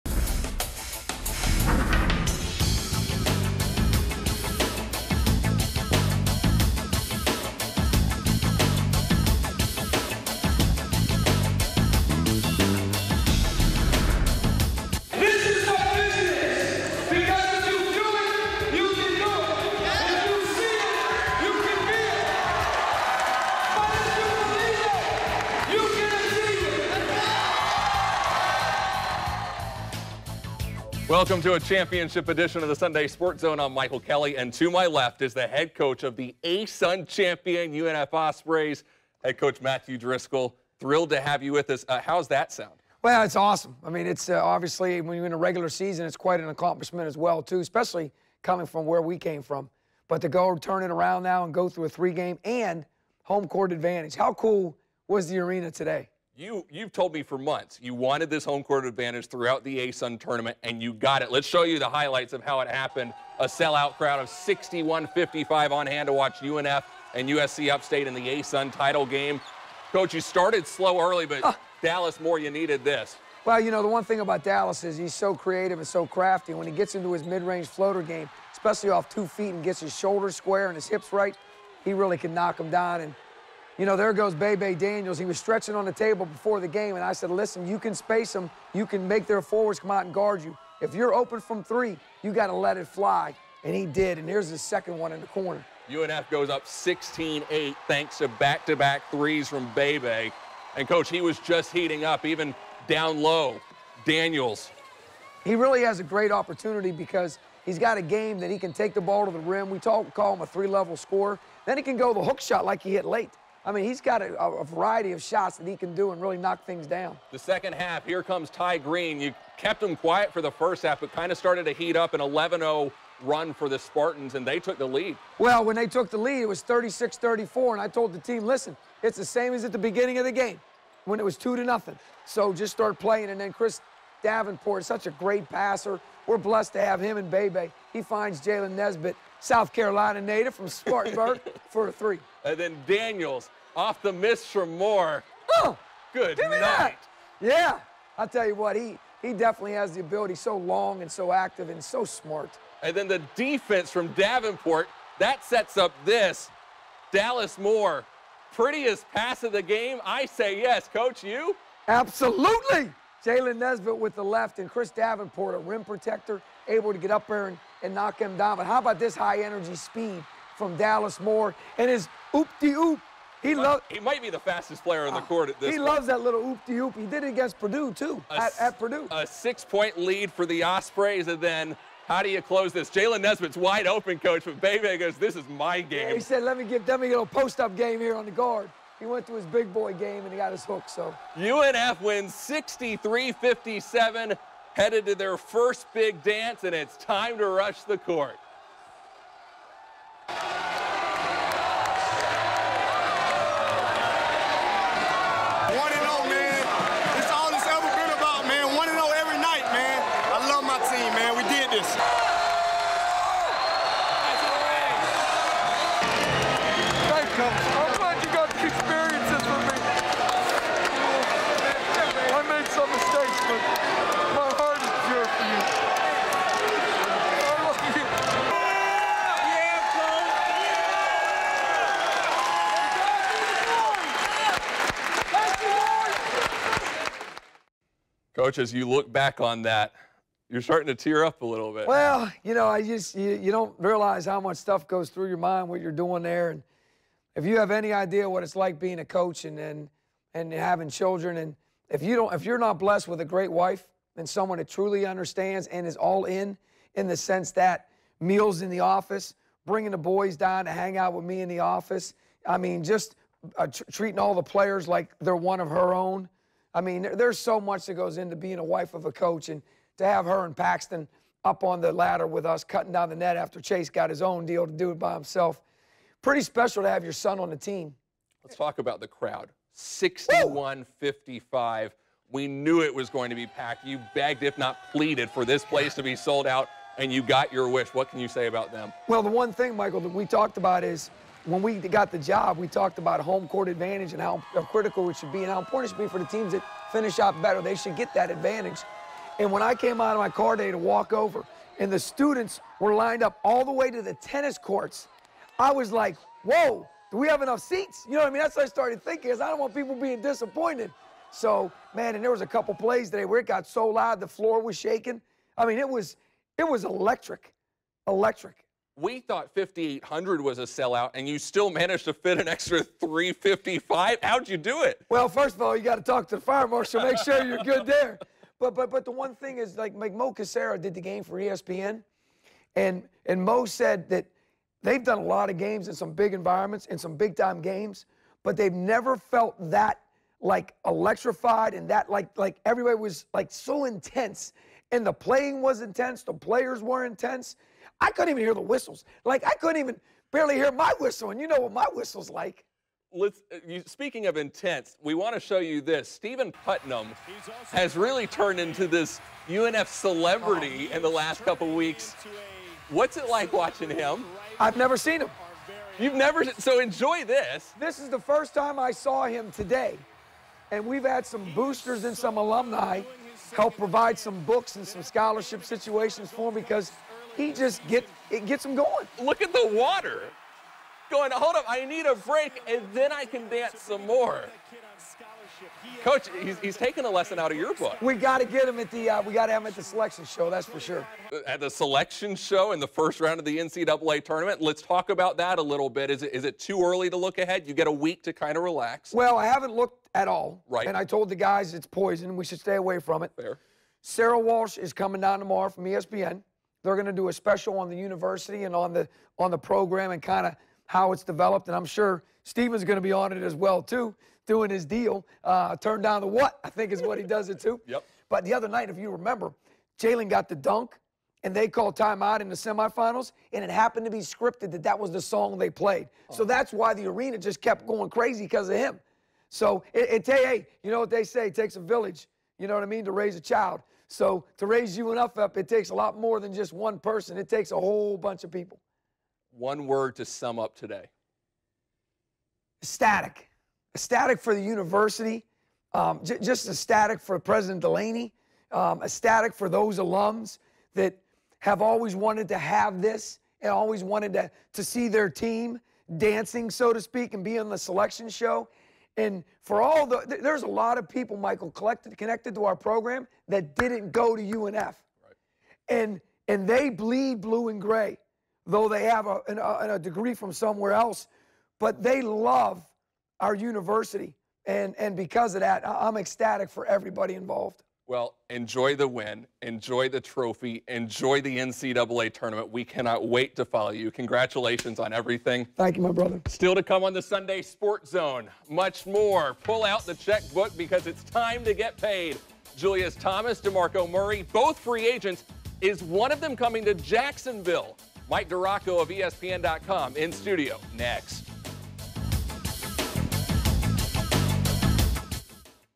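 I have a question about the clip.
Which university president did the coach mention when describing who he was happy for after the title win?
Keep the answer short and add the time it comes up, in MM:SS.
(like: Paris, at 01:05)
President Delaney, at 07:27.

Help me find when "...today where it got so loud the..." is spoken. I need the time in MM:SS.
05:13.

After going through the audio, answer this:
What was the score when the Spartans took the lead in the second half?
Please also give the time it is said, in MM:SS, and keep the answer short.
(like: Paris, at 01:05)
36-34, at 02:06.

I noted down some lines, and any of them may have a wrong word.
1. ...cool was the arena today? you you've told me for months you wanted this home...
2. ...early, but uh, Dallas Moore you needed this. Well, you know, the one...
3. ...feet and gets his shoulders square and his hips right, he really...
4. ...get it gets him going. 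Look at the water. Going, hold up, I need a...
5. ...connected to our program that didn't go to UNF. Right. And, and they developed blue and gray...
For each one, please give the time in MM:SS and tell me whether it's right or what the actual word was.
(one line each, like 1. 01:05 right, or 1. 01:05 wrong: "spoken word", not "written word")
1. 00:54 right
2. 01:10 right
3. 01:19 right
4. 06:17 right
5. 07:42 wrong: "bleed", not "developed".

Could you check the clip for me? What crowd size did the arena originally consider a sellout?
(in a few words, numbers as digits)
5,800.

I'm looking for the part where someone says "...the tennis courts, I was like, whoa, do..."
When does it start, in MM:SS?
05:04.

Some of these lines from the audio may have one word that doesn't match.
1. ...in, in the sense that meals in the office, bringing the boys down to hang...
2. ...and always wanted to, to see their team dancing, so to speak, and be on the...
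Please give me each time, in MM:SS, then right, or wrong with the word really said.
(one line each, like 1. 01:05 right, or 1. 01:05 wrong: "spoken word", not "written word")
1. 04:16 right
2. 07:33 right.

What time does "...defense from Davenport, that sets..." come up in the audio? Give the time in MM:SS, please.
02:33.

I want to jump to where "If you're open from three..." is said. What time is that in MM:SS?
01:30.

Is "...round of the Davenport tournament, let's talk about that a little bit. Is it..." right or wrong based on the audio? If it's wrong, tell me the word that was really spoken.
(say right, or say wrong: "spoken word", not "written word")
wrong: "NCAA", not "Davenport".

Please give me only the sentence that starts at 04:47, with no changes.
What can you say about them?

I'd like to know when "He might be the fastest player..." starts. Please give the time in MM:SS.
02:53.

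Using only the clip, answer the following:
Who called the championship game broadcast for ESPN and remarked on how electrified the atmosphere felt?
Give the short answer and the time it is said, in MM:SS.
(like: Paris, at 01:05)
Mo Casera, at 05:30.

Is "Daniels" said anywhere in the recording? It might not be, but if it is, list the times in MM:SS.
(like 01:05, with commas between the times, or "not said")
01:24, 01:44, 02:22.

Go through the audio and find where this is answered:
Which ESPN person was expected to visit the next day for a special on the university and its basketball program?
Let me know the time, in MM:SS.
06:44.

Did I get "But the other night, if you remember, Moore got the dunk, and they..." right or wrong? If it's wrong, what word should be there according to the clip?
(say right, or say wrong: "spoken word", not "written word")
wrong: "Jalen", not "Moore".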